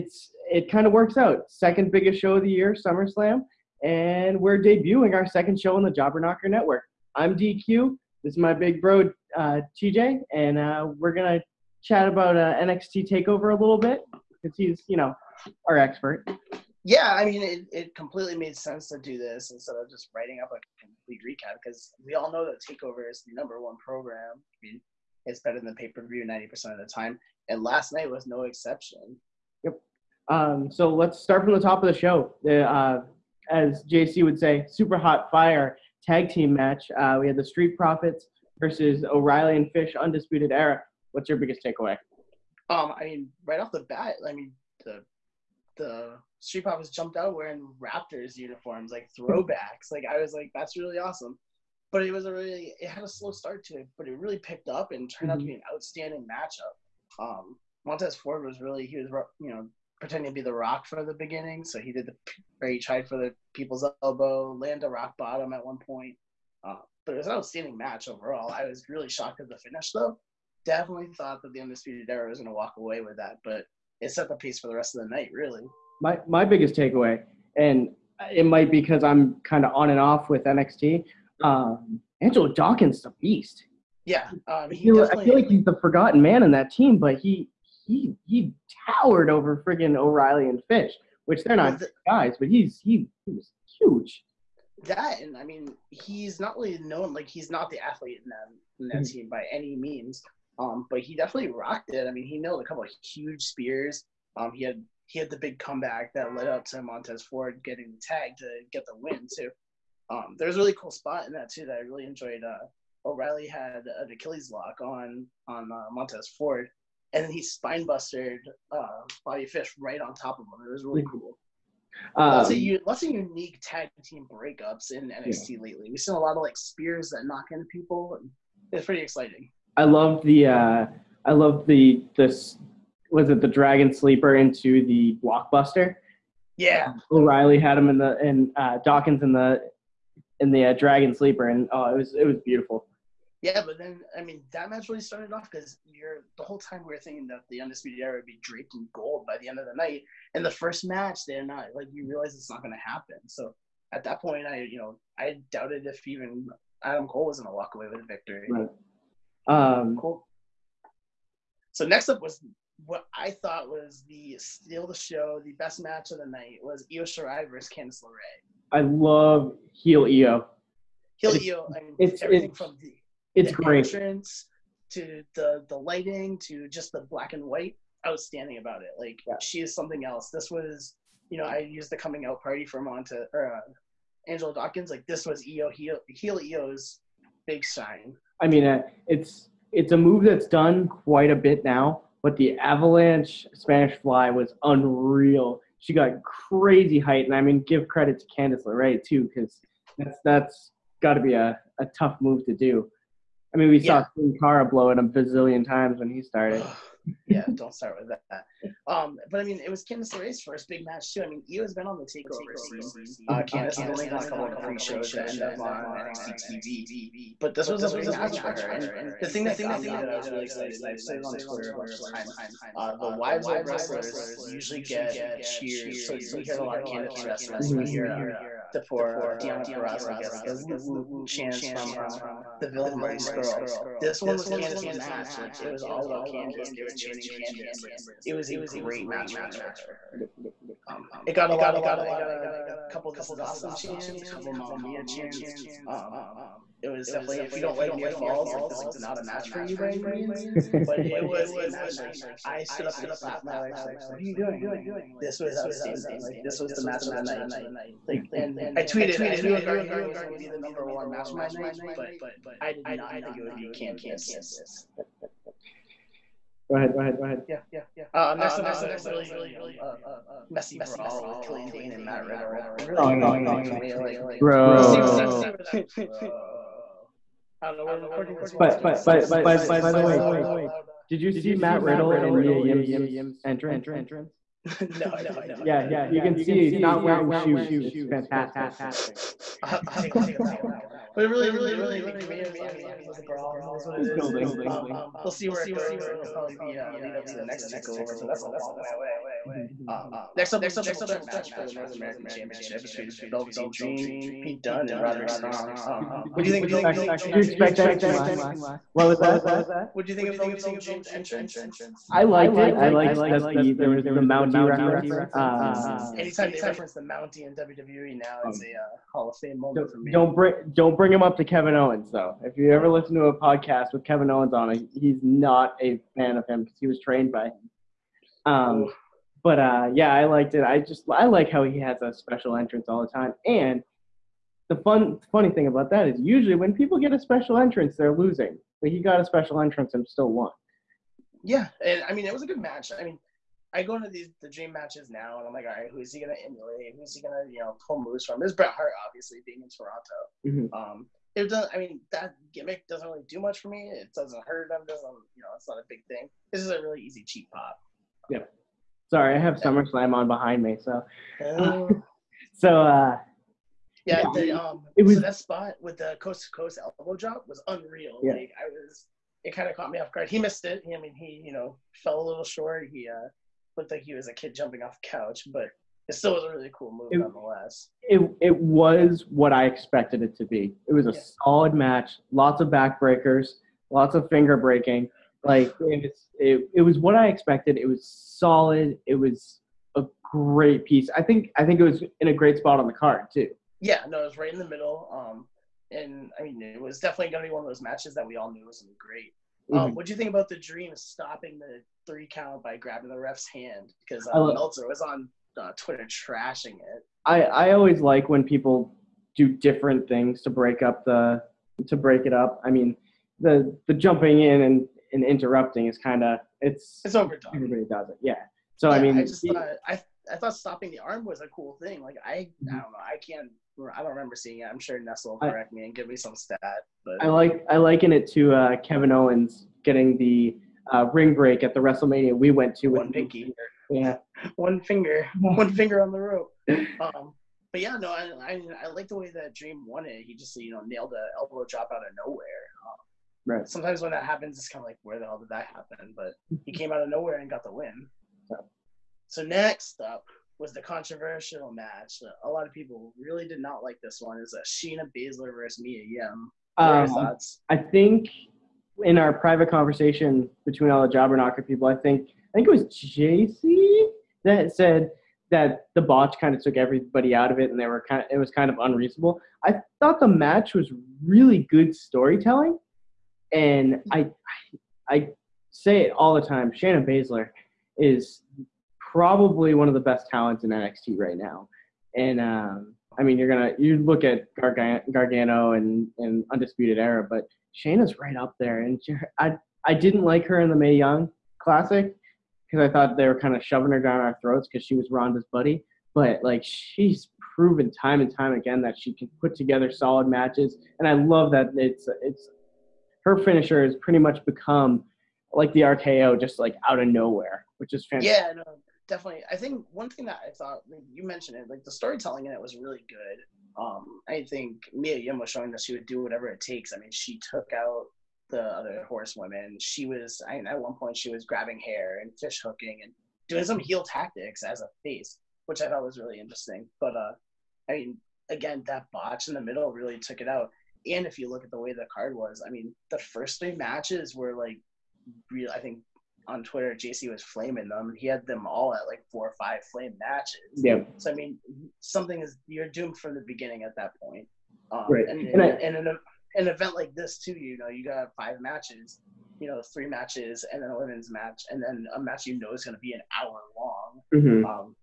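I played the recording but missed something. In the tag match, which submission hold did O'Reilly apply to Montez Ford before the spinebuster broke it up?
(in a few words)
Achilles lock.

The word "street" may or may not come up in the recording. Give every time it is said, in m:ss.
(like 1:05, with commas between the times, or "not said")
0:37, 0:46.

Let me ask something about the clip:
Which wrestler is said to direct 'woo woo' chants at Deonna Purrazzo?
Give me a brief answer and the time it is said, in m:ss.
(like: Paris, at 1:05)
Marty Scurll, at 3:52.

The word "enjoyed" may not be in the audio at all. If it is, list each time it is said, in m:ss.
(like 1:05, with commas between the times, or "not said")
1:52.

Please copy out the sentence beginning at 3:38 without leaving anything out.
And the thing that got me that I was really excited, and I've said it on Twitter a bunch of times.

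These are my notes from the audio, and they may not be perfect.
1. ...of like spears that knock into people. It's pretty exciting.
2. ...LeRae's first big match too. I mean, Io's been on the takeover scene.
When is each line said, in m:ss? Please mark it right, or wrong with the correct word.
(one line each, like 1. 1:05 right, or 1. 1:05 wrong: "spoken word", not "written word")
1. 2:06 right
2. 3:30 right.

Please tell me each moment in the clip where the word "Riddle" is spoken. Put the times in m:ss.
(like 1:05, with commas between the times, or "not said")
4:32, 4:41.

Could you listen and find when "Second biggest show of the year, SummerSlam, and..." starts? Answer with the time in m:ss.
0:01.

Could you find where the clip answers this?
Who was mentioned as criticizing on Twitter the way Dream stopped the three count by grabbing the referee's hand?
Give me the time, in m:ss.
6:44.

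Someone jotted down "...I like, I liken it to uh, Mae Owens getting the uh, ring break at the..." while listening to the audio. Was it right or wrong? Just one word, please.
wrong.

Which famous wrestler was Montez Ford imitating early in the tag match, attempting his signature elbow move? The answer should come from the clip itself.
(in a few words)
The Rock.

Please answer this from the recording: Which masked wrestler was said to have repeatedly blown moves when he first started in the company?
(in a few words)
Sin Cara.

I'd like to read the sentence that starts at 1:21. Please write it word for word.
Um, Angelo Dawkins is a beast.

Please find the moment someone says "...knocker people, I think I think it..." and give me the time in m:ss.
7:41.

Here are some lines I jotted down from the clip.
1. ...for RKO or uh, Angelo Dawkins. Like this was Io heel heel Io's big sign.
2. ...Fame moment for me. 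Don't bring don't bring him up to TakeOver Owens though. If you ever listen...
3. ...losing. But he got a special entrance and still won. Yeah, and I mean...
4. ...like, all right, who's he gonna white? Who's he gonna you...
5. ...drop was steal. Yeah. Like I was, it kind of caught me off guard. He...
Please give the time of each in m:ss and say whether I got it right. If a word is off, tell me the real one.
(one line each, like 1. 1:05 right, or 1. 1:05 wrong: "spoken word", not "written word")
1. 3:02 wrong: "Monta", not "RKO"
2. 5:19 wrong: "Kevin", not "TakeOver"
3. 5:38 right
4. 5:45 wrong: "emulate", not "white"
5. 6:07 wrong: "unreal", not "steal".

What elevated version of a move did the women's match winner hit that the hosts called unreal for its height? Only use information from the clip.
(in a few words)
Avalanche Spanish Fly.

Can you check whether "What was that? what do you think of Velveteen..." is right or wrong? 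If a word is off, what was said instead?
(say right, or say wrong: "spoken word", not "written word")
right.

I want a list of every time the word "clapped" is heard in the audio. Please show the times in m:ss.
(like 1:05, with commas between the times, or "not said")
4:13.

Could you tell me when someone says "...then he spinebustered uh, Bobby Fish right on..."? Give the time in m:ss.
1:57.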